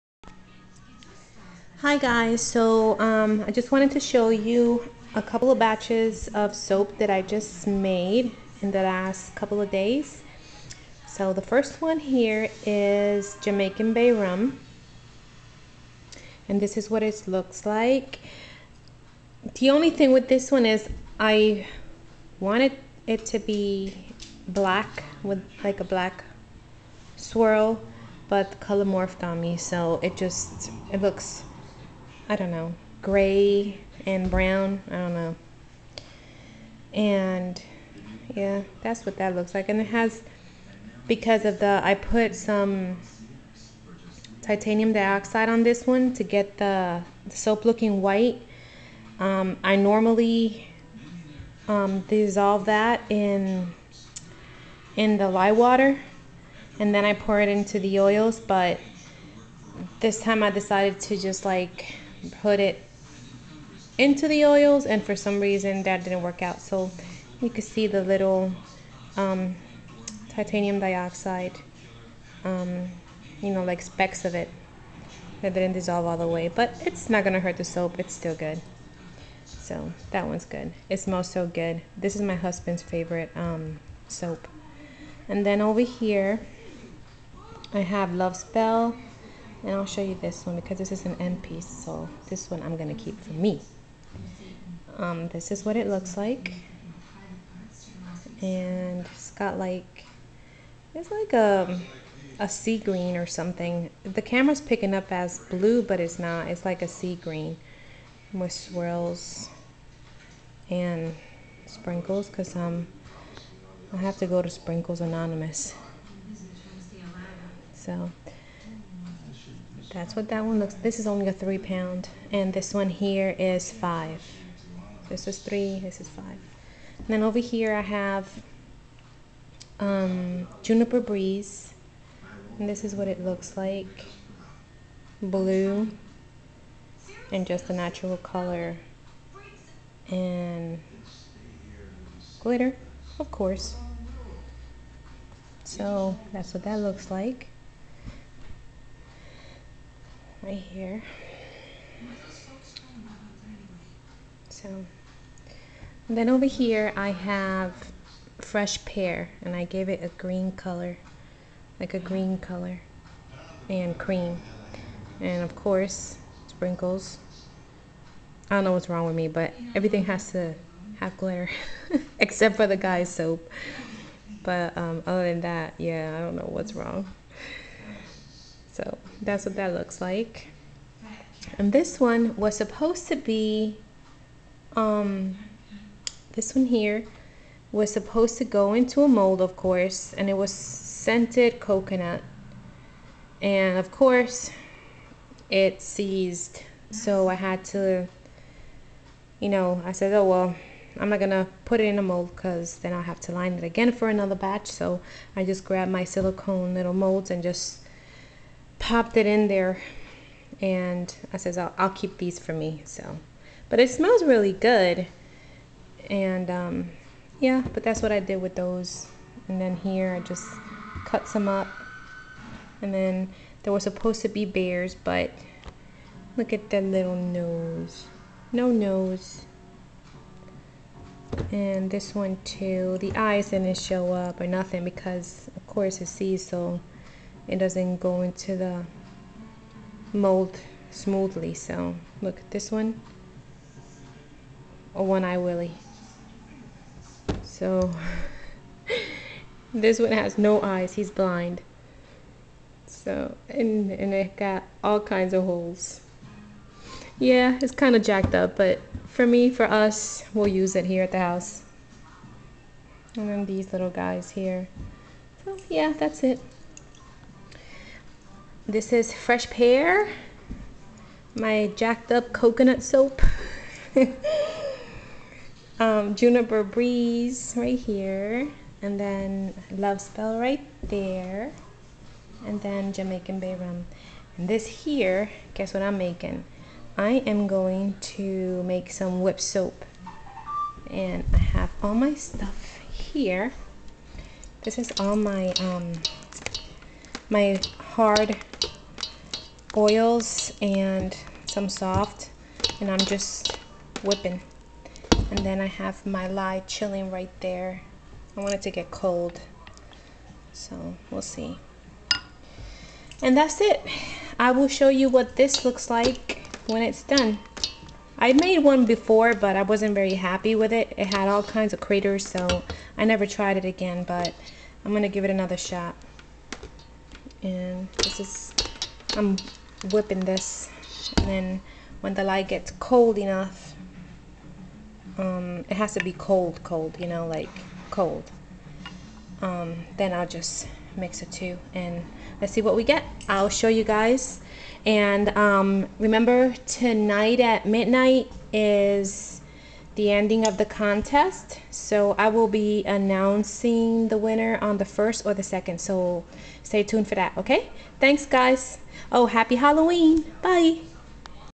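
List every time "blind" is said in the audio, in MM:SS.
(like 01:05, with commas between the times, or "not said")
04:11.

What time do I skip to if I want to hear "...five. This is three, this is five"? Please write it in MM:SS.
02:03.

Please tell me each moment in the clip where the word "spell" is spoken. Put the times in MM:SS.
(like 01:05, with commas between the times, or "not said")
01:28, 04:39.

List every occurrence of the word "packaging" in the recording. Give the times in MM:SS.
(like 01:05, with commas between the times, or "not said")
not said.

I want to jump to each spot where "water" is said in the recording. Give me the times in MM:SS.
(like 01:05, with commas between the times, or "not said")
00:55.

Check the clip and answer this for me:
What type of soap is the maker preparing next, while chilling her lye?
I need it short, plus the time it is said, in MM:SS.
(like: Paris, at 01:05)
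whip soap, at 04:49.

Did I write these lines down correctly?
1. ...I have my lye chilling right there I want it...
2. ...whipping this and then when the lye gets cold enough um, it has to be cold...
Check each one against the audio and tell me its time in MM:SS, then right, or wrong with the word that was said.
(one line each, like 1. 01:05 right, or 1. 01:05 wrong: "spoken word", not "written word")
1. 05:05 right
2. 05:29 right.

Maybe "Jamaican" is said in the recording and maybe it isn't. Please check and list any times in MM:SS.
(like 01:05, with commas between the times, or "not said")
00:13, 04:42.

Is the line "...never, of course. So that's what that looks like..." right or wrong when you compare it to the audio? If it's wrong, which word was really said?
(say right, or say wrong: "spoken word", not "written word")
wrong: "glitter", not "never".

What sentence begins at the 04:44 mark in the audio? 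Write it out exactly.
And this here, guess what I'm making?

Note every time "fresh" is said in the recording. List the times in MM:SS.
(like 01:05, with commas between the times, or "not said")
02:38, 04:29.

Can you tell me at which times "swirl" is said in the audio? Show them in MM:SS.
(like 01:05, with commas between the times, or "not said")
00:27, 01:48.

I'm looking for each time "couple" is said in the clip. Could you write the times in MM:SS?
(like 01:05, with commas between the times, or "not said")
00:05, 00:09.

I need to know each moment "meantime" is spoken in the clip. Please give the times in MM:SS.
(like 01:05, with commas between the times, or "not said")
not said.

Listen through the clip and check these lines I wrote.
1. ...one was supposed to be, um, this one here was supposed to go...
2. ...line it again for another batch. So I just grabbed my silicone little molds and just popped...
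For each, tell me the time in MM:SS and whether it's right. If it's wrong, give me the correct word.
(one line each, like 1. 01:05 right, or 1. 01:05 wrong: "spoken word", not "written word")
1. 03:01 right
2. 03:23 right.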